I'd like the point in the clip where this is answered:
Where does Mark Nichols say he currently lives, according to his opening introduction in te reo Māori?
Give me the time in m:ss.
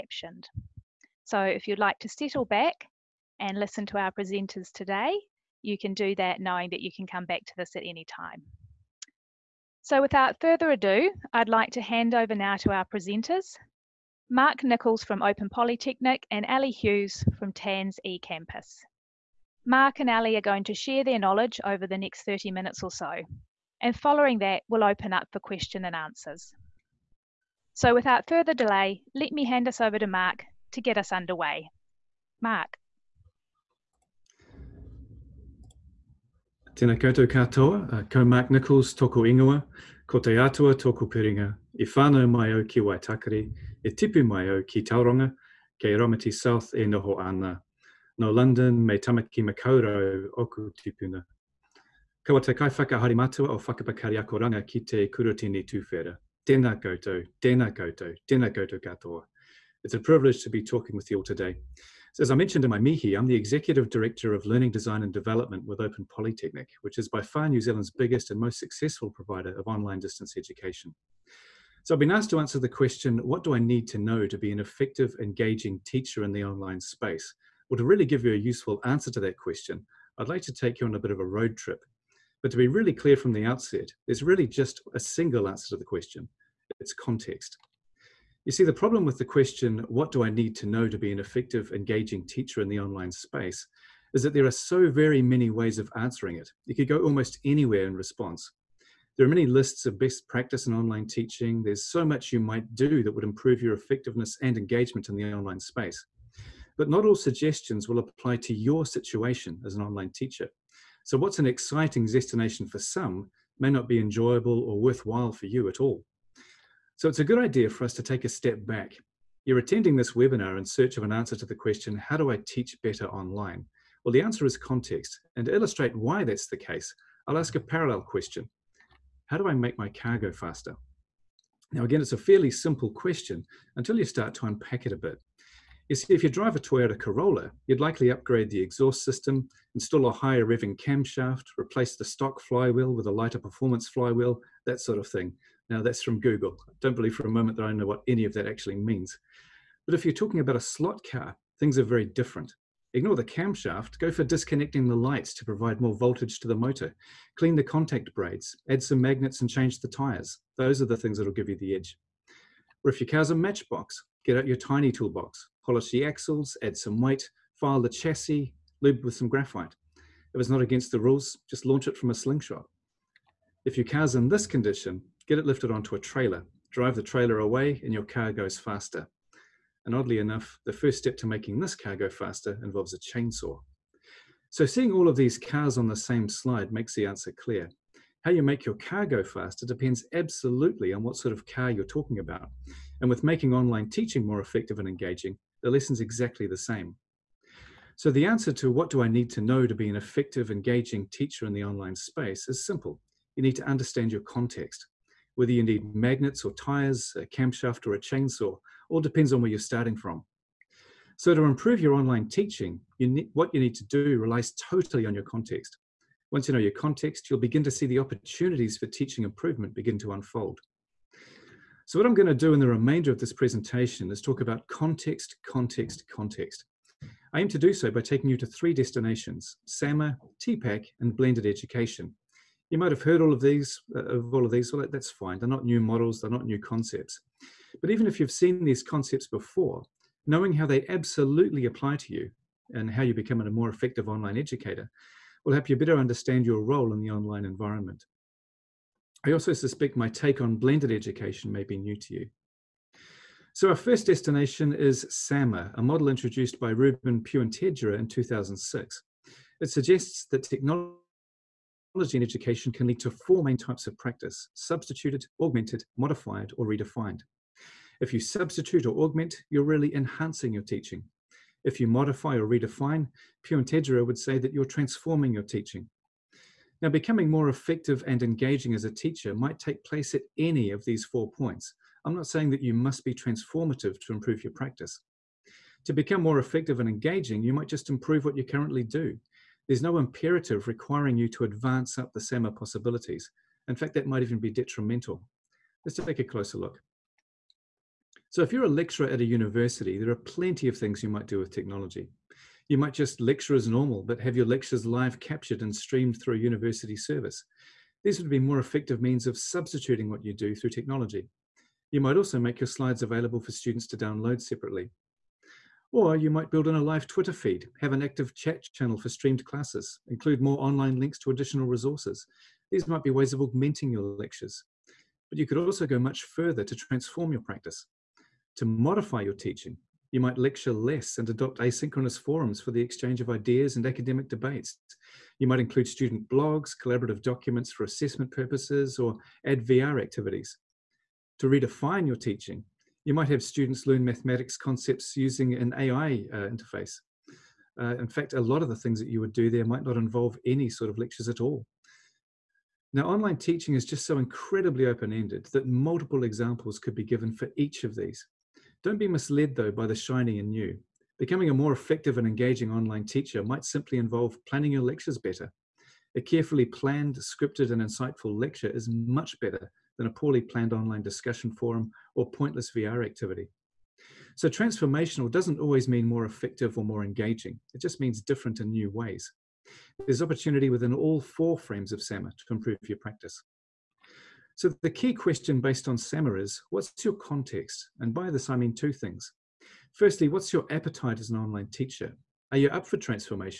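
0:45.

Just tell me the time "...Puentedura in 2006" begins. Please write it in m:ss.
4:17.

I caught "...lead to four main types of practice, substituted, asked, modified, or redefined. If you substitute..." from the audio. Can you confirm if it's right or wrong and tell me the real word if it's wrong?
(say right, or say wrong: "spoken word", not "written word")
wrong: "augmented", not "asked".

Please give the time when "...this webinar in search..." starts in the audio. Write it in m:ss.
1:59.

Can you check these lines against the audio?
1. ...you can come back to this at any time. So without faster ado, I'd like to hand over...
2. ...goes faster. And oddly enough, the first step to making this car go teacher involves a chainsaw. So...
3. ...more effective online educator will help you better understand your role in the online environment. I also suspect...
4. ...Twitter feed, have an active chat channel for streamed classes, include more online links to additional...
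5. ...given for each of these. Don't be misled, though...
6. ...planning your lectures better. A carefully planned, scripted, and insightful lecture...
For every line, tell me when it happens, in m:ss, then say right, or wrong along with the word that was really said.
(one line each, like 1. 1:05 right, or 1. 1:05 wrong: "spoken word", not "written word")
1. 0:06 wrong: "further", not "faster"
2. 2:58 wrong: "faster", not "teacher"
3. 4:03 right
4. 5:17 right
5. 5:57 right
6. 6:04 right.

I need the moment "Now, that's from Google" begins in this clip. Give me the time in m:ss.
2:25.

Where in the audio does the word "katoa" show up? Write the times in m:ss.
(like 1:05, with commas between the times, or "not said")
0:37, 0:58.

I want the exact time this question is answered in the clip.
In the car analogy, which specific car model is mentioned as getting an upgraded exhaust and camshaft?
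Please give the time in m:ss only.
2:16.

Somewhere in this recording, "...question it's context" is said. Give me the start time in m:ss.
1:25.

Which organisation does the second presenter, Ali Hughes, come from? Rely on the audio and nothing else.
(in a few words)
TANZ eCampus.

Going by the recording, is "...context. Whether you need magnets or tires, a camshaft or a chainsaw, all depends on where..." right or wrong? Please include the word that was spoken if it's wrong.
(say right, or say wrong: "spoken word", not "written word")
right.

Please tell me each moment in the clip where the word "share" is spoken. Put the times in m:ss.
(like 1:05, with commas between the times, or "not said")
0:20.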